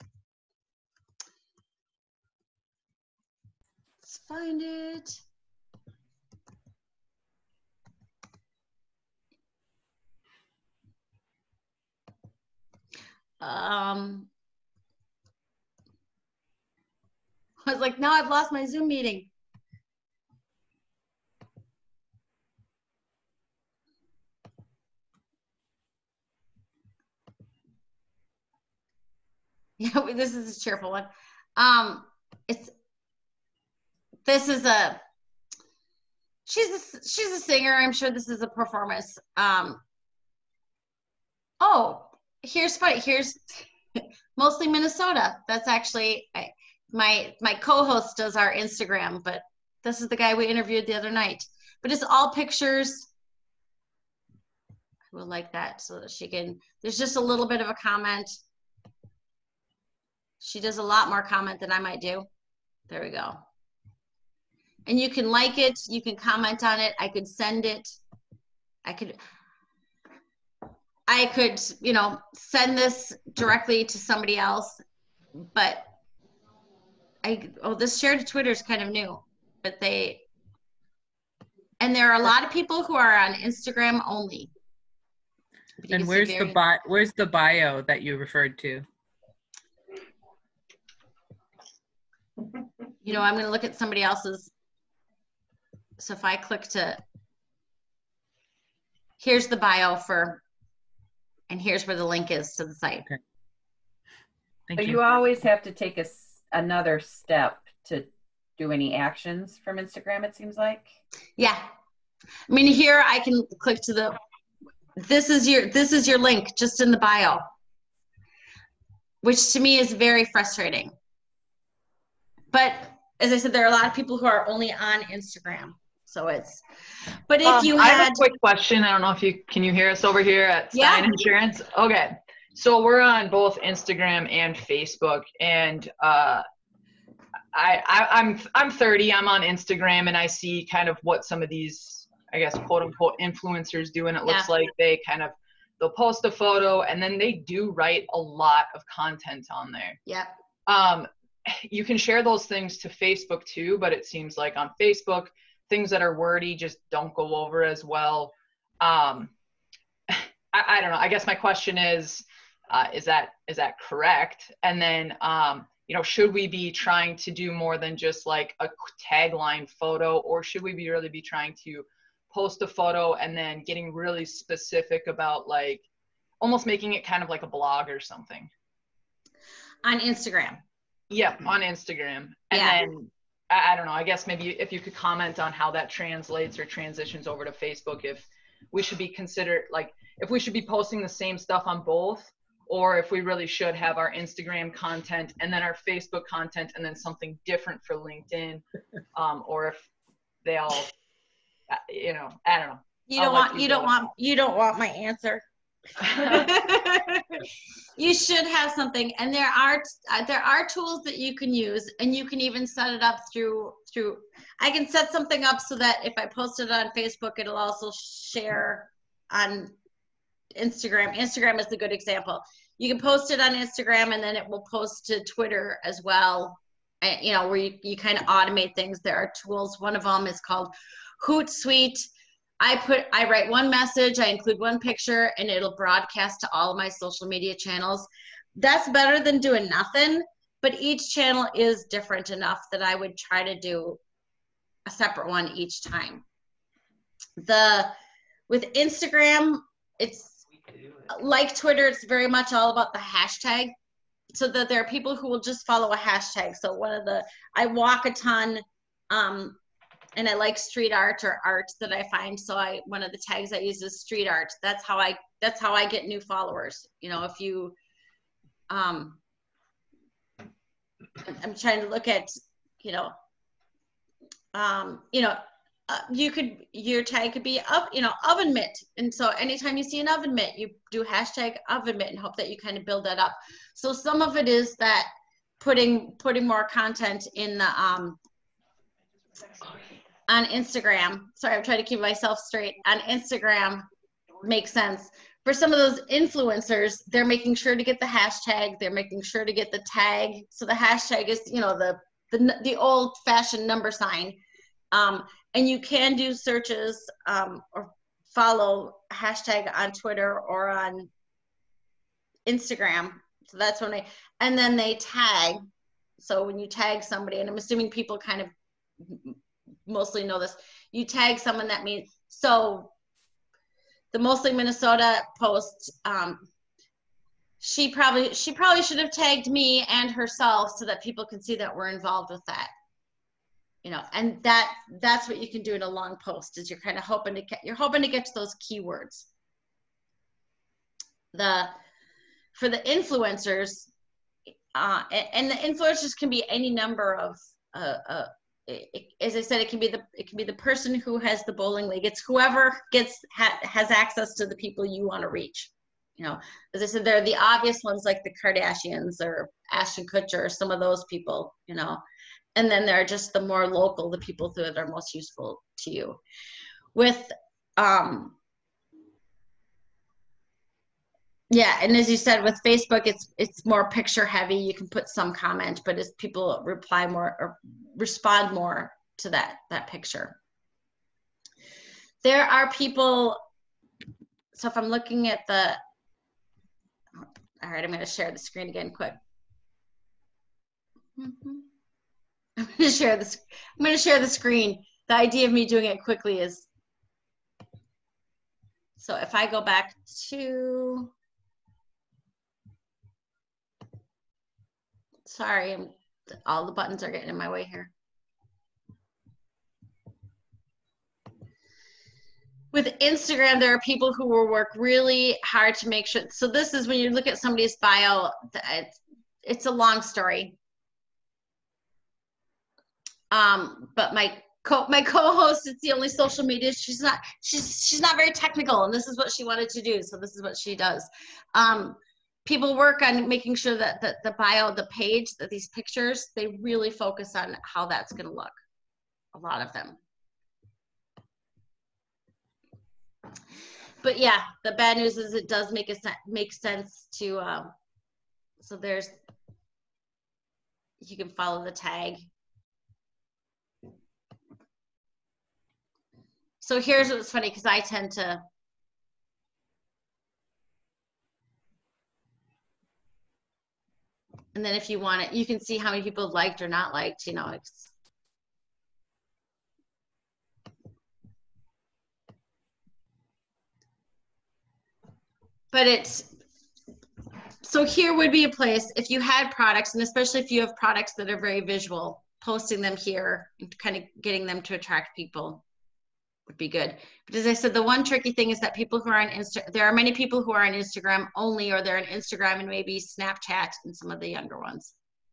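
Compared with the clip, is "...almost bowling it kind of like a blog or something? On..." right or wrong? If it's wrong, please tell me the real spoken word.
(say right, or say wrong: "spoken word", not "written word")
wrong: "making", not "bowling".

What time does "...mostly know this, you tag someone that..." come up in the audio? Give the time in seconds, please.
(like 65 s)
319 s.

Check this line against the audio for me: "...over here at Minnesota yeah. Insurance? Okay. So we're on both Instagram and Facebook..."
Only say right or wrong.
wrong.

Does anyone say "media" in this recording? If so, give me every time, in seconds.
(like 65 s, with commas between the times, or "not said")
237 s, 426 s.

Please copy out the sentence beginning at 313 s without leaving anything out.
So that's when they, and then they tag.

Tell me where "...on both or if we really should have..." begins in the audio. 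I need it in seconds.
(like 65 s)
191 s.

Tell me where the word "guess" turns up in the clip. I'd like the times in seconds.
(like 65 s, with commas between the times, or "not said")
142 s, 161 s, 184 s.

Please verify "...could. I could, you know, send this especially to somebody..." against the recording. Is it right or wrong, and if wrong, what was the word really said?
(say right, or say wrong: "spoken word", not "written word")
wrong: "directly", not "especially".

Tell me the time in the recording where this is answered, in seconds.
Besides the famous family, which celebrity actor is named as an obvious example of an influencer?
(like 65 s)
359 s.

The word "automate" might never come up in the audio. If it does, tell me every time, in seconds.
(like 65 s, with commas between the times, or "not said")
228 s.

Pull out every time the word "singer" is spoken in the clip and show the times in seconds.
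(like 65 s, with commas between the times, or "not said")
37 s.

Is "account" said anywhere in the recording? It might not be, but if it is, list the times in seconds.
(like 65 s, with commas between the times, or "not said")
not said.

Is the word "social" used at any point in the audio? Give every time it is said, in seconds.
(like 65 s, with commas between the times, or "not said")
236 s, 426 s.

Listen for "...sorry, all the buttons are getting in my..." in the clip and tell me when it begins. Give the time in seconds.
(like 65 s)
405 s.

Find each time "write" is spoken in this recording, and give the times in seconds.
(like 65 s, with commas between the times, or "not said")
147 s, 233 s.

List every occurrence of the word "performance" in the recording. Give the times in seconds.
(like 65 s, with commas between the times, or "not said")
38 s.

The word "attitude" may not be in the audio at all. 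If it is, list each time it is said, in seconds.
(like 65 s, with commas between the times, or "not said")
not said.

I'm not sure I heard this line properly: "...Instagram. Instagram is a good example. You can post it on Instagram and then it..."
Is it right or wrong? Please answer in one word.
right.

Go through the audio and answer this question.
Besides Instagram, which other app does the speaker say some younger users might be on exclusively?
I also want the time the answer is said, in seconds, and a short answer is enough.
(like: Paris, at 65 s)
Snapchat, at 493 s.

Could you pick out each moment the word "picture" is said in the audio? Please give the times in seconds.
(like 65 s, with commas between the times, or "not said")
52 s, 234 s, 373 s, 379 s, 435 s.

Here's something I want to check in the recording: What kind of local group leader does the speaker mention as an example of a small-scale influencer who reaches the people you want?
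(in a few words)
bowling league.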